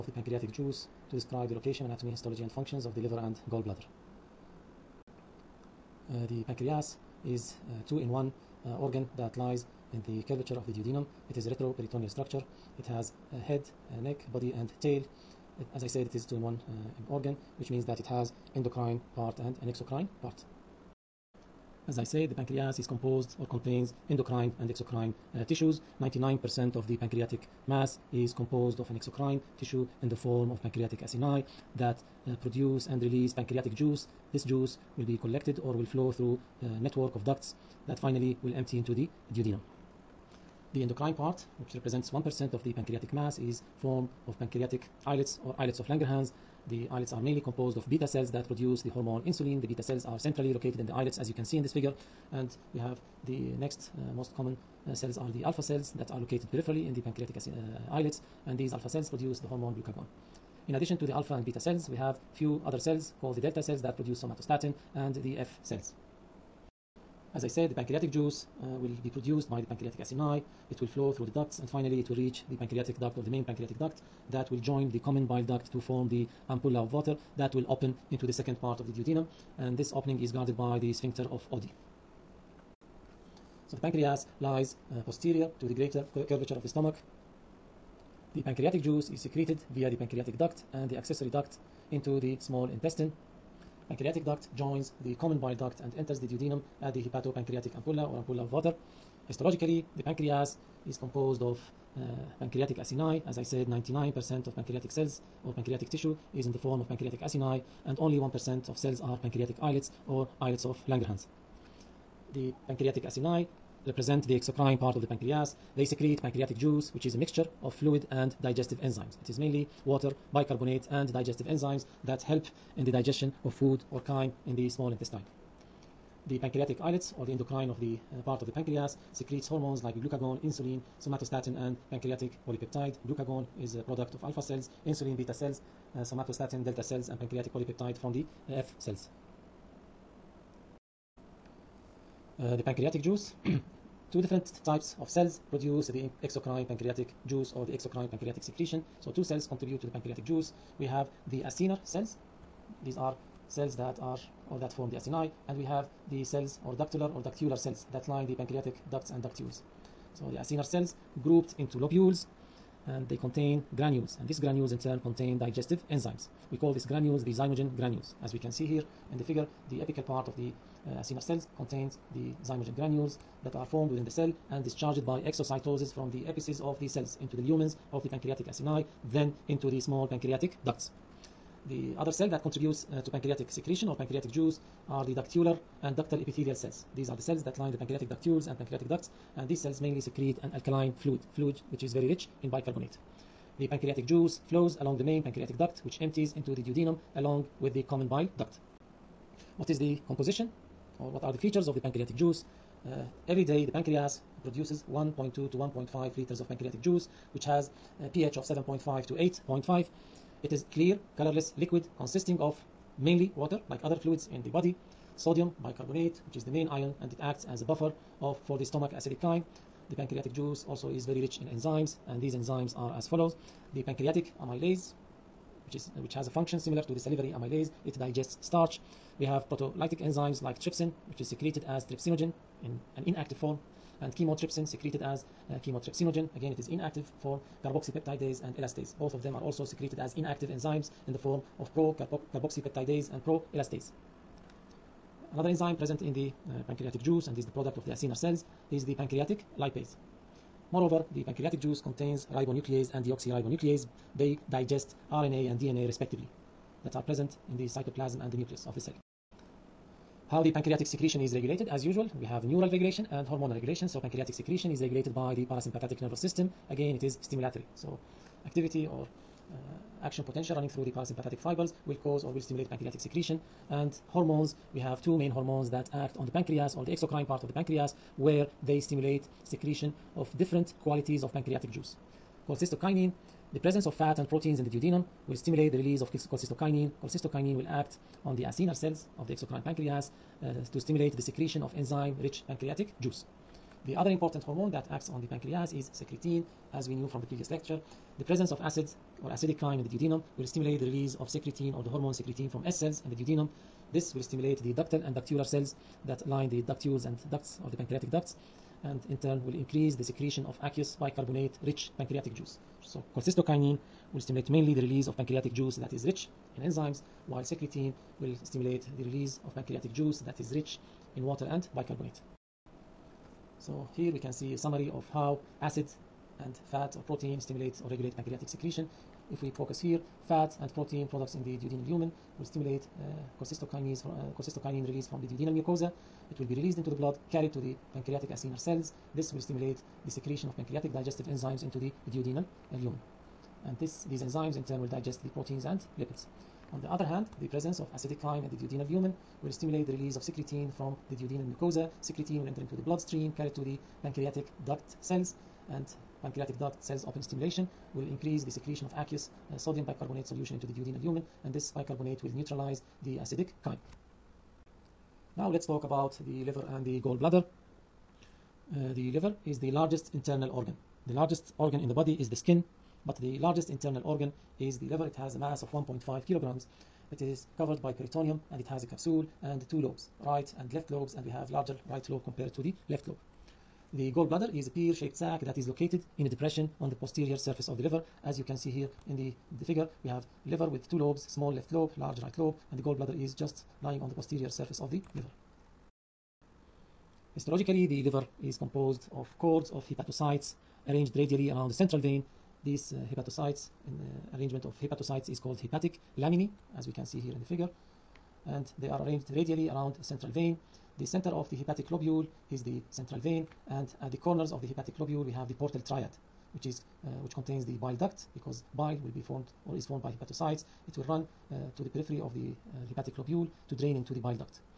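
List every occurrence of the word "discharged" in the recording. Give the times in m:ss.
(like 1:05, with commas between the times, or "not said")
2:54.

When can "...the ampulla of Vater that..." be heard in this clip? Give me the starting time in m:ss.
1:16.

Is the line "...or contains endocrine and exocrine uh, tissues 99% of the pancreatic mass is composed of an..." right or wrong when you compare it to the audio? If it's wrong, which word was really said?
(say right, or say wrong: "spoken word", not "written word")
right.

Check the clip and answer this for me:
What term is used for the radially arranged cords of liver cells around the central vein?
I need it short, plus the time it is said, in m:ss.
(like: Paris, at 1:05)
hepatic laminae, at 6:45.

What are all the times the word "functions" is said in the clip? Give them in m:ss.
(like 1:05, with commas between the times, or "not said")
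0:02, 3:46.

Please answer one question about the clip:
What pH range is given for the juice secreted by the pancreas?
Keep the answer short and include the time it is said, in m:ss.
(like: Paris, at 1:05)
7.5 to 8.5, at 3:28.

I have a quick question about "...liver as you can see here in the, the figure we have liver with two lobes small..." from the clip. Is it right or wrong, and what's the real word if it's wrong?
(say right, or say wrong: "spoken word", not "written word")
right.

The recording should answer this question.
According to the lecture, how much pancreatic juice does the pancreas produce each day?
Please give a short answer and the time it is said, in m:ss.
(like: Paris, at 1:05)
1.2 to 1.5 liters, at 3:24.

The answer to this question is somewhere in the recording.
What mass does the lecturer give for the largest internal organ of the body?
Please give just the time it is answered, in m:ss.
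6:15.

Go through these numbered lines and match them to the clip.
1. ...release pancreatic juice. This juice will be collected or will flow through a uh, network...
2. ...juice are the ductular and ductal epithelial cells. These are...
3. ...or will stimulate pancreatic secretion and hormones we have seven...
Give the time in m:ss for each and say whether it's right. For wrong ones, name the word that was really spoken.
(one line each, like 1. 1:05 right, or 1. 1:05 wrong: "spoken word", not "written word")
1. 0:33 right
2. 3:04 right
3. 4:32 wrong: "two", not "seven".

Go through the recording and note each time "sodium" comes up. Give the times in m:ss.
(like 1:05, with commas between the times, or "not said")
3:35, 5:59.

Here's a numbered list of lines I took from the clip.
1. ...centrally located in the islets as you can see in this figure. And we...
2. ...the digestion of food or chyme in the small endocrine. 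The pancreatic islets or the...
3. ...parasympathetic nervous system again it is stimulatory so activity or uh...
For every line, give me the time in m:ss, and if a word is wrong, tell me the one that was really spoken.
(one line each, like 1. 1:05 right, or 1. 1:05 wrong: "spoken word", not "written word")
1. 0:50 right
2. 2:02 wrong: "intestine", not "endocrine"
3. 4:25 right.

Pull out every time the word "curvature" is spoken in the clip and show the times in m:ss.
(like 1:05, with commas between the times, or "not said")
0:10, 1:26.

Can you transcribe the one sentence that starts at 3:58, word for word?
Both of them are also secreted as inactive enzymes in the form of pro-carboxypeptidase and pro-elastase.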